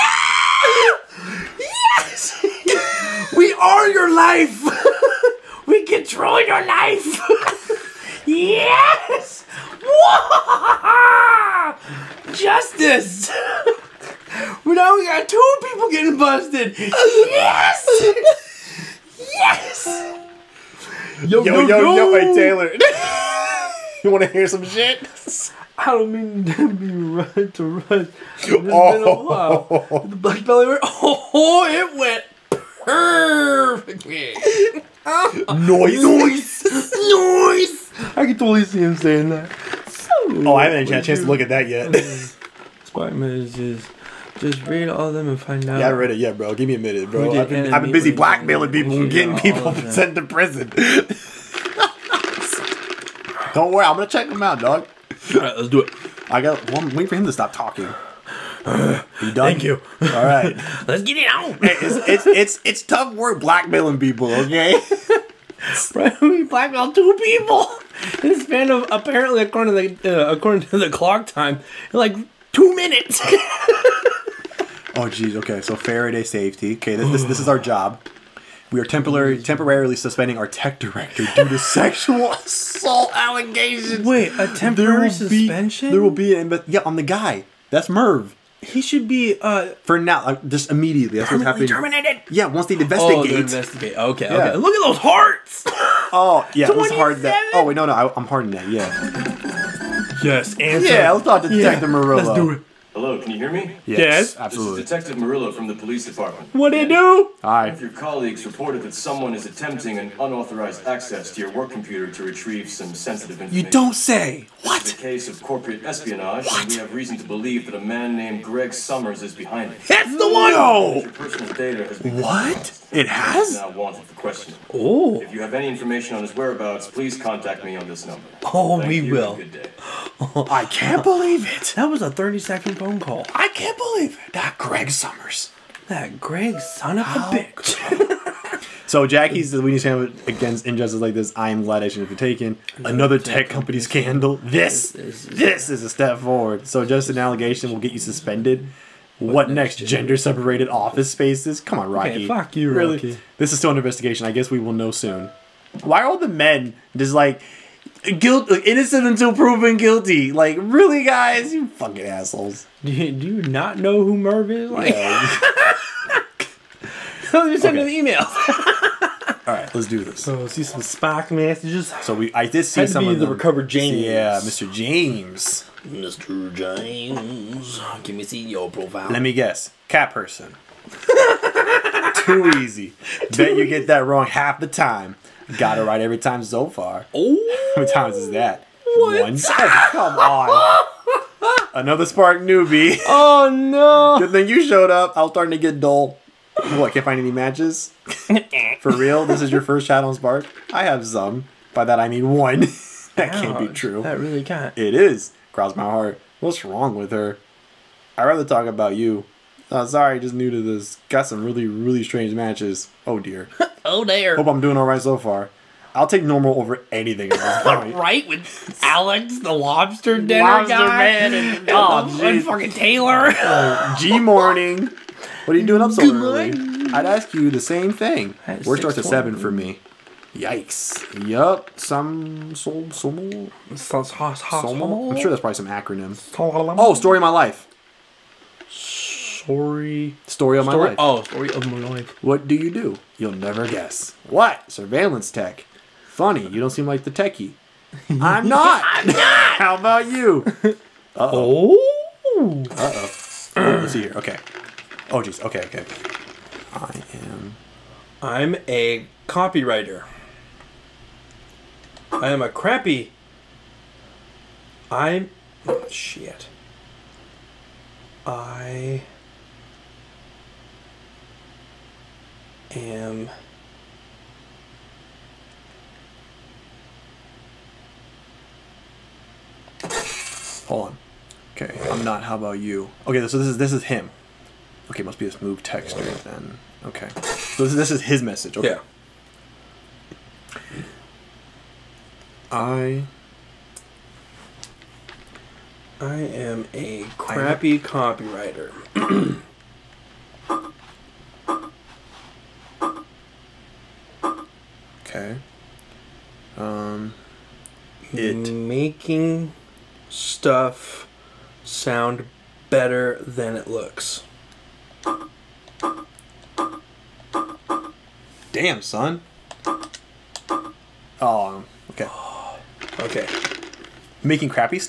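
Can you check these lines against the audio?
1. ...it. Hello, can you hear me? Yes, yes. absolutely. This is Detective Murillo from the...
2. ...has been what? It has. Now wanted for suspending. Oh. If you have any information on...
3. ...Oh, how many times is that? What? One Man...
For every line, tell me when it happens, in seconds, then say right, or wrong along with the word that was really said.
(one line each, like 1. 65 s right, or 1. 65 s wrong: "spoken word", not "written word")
1. 102 s right
2. 121 s wrong: "questioning", not "suspending"
3. 187 s wrong: "Come", not "Man".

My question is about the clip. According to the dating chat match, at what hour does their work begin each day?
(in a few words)
7.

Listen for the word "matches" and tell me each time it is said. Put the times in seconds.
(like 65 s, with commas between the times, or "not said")
197 s, 212 s.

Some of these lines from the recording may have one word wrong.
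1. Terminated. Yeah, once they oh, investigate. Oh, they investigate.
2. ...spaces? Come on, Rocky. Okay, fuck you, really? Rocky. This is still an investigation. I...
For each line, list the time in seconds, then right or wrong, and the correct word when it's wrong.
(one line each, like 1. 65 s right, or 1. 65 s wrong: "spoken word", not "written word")
1. 91 s right
2. 151 s right.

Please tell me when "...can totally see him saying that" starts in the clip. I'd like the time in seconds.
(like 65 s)
38 s.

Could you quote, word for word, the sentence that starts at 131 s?
That was a 30 second phone call.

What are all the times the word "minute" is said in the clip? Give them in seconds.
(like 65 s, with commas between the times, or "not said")
46 s, 72 s.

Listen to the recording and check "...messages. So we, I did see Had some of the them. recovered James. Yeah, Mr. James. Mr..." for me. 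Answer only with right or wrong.
right.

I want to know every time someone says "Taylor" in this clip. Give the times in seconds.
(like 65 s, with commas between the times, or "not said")
22 s, 222 s.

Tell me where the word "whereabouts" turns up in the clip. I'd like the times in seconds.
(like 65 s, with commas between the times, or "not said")
126 s.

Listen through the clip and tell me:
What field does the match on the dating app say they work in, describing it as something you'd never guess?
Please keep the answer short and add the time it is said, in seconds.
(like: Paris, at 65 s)
Surveillance tech, at 244 s.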